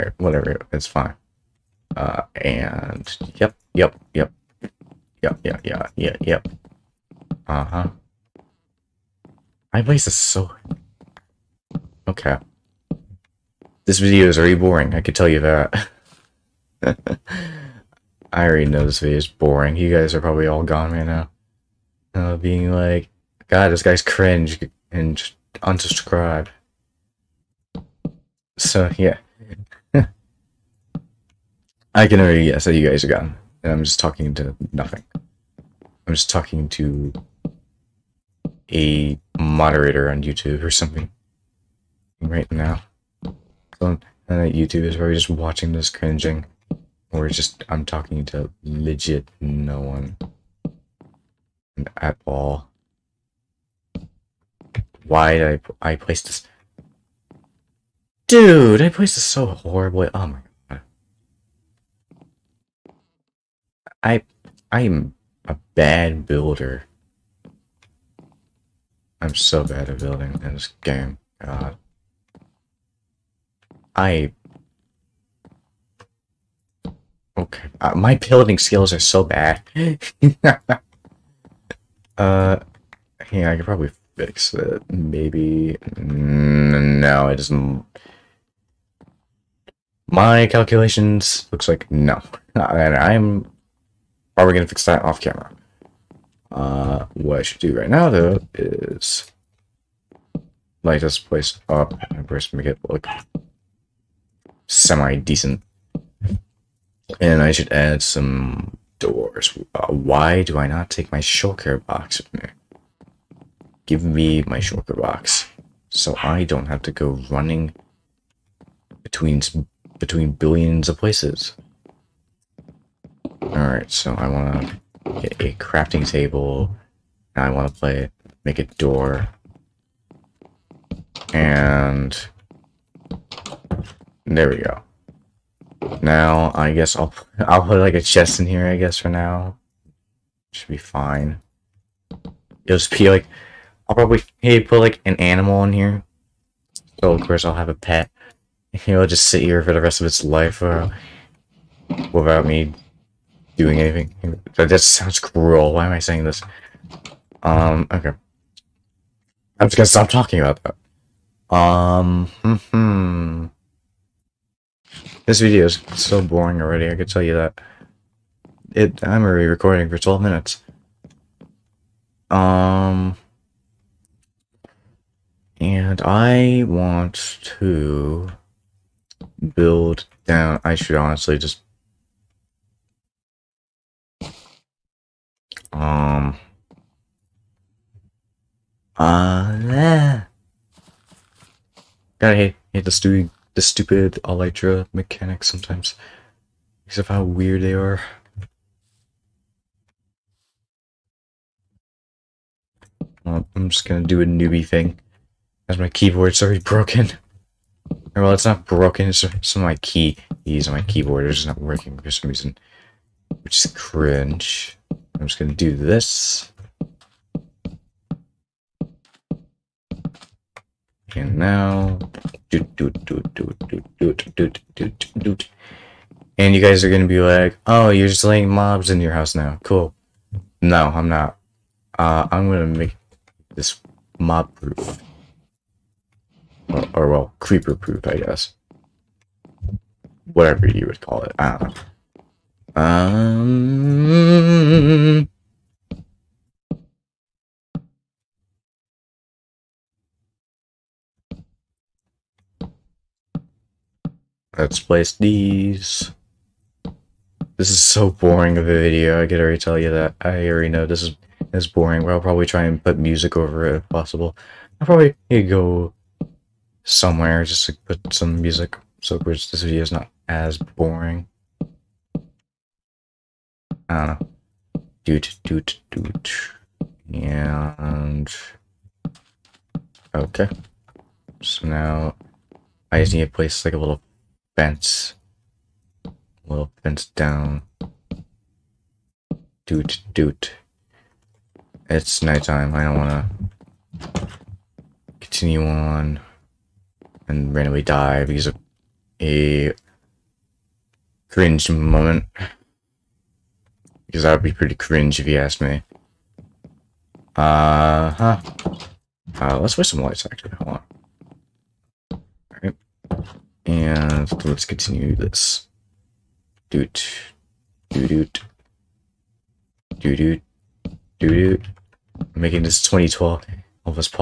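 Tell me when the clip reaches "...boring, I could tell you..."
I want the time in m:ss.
0:14.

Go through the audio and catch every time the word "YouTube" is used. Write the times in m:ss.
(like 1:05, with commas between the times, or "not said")
0:40, 0:44.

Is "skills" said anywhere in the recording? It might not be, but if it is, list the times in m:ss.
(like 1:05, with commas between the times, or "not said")
1:18.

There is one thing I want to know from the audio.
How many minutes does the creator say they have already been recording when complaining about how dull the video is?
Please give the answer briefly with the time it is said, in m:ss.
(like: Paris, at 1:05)
12, at 2:49.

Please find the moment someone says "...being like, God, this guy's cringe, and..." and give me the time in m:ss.
0:22.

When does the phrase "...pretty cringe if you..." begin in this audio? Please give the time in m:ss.
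5:04.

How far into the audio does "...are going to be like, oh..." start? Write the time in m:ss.
3:46.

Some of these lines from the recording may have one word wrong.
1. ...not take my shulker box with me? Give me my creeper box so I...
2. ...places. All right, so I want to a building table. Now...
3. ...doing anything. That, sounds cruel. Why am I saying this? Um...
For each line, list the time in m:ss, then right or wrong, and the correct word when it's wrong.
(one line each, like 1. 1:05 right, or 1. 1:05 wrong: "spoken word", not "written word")
1. 1:50 wrong: "shulker", not "creeper"
2. 2:00 wrong: "crafting", not "building"
3. 2:33 right.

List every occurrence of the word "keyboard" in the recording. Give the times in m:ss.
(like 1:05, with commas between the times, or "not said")
3:25, 3:30.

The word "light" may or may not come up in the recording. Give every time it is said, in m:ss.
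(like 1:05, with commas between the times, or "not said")
1:40, 5:10.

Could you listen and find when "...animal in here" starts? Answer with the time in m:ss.
2:25.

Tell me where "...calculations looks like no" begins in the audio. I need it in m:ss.
1:30.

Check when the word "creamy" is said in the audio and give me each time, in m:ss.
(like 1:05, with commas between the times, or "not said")
not said.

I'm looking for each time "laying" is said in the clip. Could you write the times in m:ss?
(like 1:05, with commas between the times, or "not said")
3:48.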